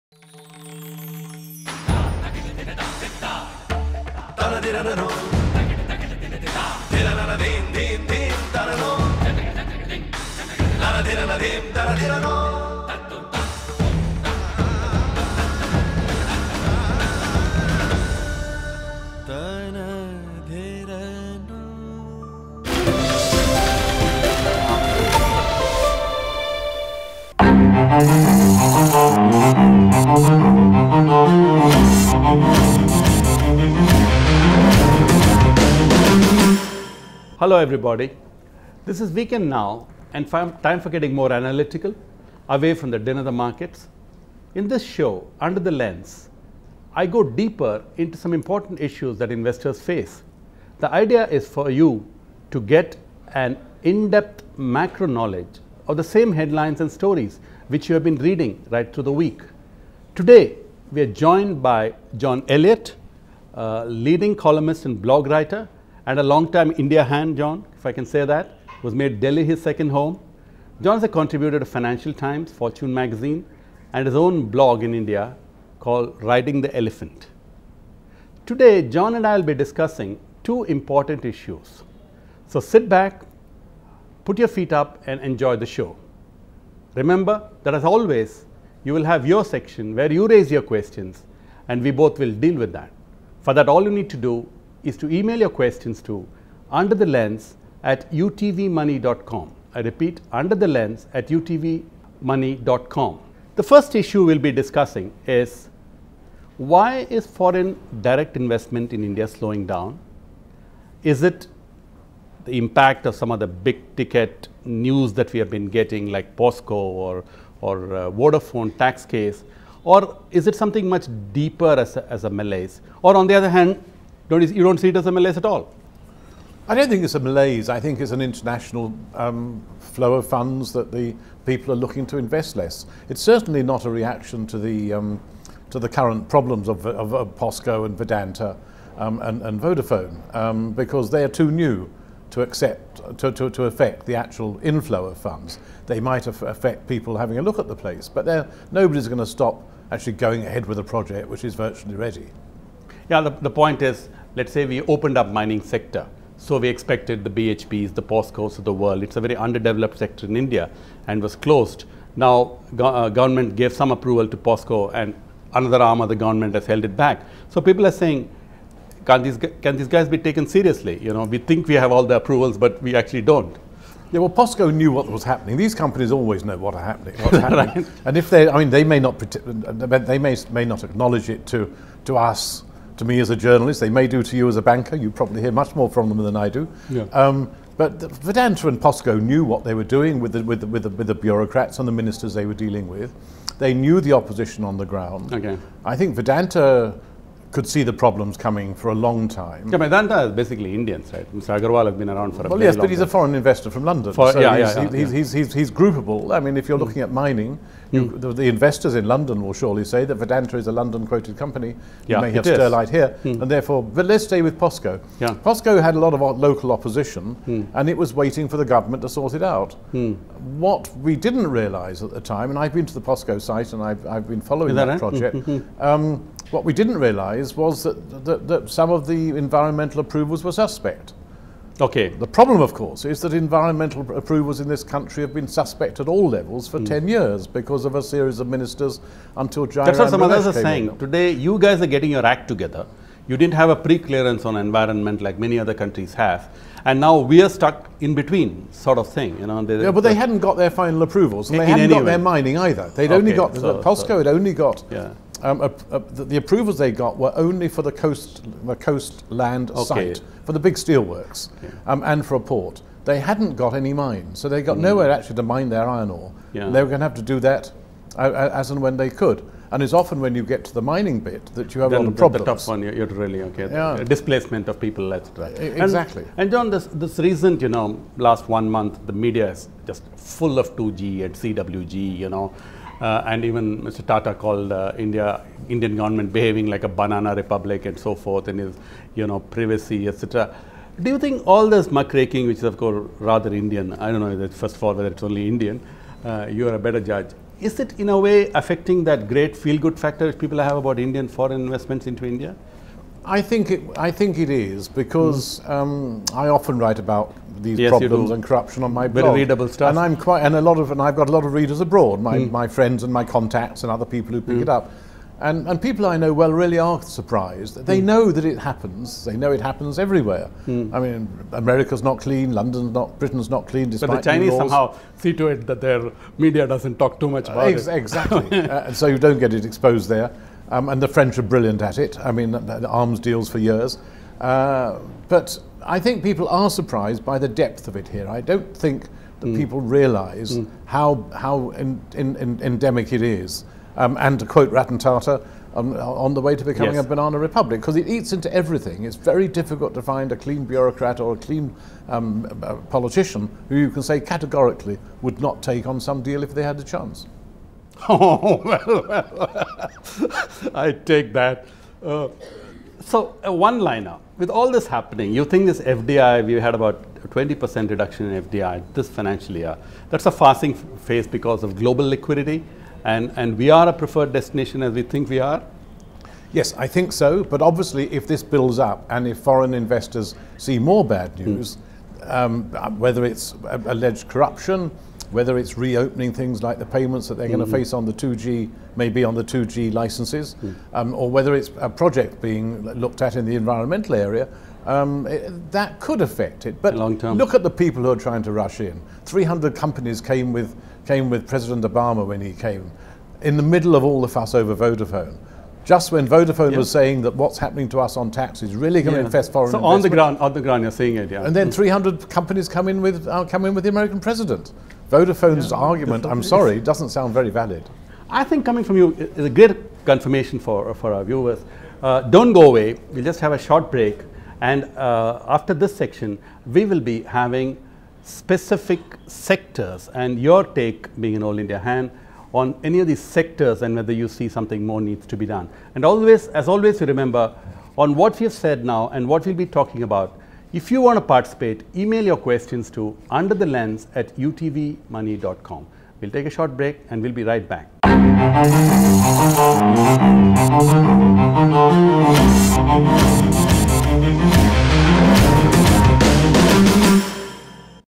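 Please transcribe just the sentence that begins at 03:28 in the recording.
the, the, investors in London will surely say that Vedanta is a London quoted company.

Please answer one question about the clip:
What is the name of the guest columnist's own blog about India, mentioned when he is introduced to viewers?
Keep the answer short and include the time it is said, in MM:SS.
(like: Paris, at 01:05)
Riding the Elephant, at 01:16.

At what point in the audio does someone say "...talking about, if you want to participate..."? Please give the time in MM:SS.
07:19.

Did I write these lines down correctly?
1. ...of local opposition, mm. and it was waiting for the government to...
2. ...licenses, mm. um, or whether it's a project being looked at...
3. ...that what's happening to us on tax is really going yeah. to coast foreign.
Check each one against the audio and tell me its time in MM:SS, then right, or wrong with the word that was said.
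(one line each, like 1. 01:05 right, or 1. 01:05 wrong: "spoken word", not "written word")
1. 03:36 right
2. 06:29 right
3. 06:47 wrong: "infest", not "coast".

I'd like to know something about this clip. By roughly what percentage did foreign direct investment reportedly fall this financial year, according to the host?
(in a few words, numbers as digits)
20%.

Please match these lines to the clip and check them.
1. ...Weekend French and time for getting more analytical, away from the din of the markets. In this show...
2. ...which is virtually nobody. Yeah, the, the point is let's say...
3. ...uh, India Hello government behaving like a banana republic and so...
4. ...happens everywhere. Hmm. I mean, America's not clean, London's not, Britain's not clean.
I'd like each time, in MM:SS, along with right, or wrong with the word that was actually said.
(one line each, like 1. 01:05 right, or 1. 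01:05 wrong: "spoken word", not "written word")
1. 00:39 wrong: "Now", not "French"
2. 02:31 wrong: "ready", not "nobody"
3. 04:44 wrong: "Indian", not "Hello"
4. 05:19 right.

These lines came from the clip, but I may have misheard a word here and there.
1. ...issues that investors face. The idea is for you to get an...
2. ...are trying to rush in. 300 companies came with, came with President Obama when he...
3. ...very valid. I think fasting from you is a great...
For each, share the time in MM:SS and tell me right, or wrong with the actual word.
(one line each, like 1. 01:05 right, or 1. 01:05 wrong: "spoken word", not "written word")
1. 00:48 right
2. 06:38 right
3. 06:57 wrong: "coming", not "fasting".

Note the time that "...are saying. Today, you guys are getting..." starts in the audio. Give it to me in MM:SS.
04:00.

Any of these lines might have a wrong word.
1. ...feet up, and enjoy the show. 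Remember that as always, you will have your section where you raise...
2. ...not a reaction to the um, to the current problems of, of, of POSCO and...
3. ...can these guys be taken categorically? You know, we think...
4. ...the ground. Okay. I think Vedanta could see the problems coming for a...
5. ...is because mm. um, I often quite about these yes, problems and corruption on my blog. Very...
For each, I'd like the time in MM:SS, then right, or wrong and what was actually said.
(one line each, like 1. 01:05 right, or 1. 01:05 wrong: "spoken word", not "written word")
1. 01:24 right
2. 02:13 right
3. 02:49 wrong: "seriously", not "categorically"
4. 03:14 right
5. 05:04 wrong: "write", not "quite".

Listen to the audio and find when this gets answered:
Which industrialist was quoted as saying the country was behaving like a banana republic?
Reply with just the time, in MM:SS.
05:44.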